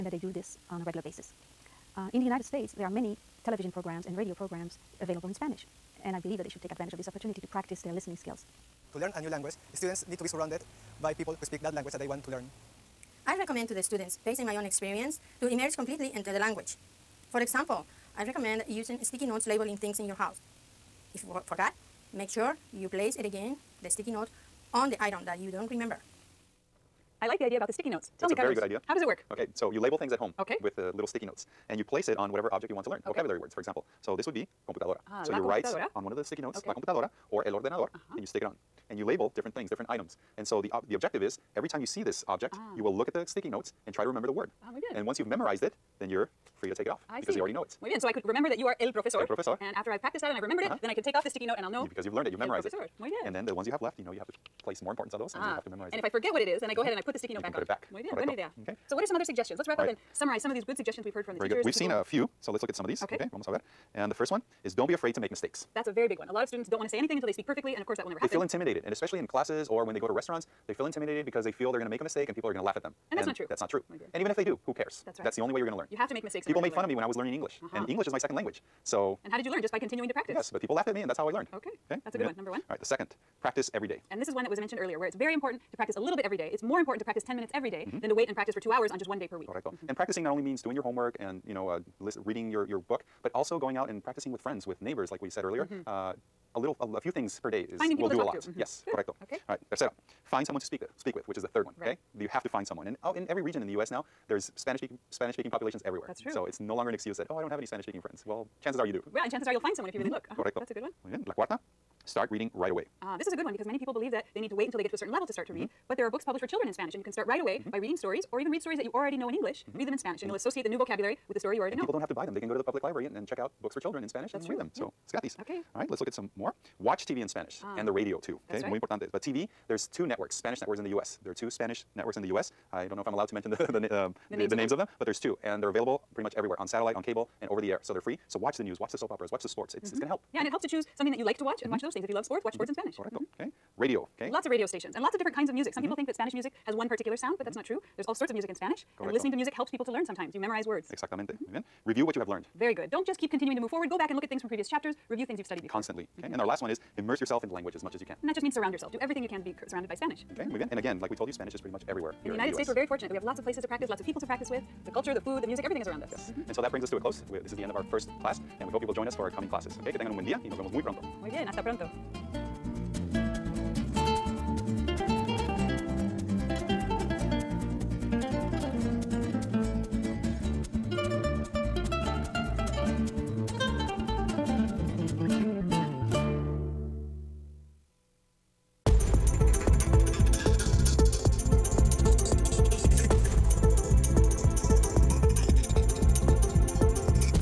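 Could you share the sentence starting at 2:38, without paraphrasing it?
And that just means surround yourself.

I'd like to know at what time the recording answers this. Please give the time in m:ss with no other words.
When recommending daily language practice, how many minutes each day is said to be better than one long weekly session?
1:27.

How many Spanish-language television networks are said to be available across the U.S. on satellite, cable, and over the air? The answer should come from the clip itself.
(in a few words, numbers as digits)
2.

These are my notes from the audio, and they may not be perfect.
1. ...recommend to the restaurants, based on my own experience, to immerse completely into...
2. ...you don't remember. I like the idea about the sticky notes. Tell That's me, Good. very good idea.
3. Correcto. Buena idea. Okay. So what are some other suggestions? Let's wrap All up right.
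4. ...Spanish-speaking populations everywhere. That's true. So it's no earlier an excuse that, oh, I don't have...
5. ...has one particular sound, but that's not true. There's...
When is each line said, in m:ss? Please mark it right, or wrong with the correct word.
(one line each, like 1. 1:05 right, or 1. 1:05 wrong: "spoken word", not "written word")
1. 0:13 wrong: "students", not "restaurants"
2. 0:25 wrong: "Carlos", not "Good"
3. 0:58 right
4. 1:45 wrong: "longer", not "earlier"
5. 2:26 right.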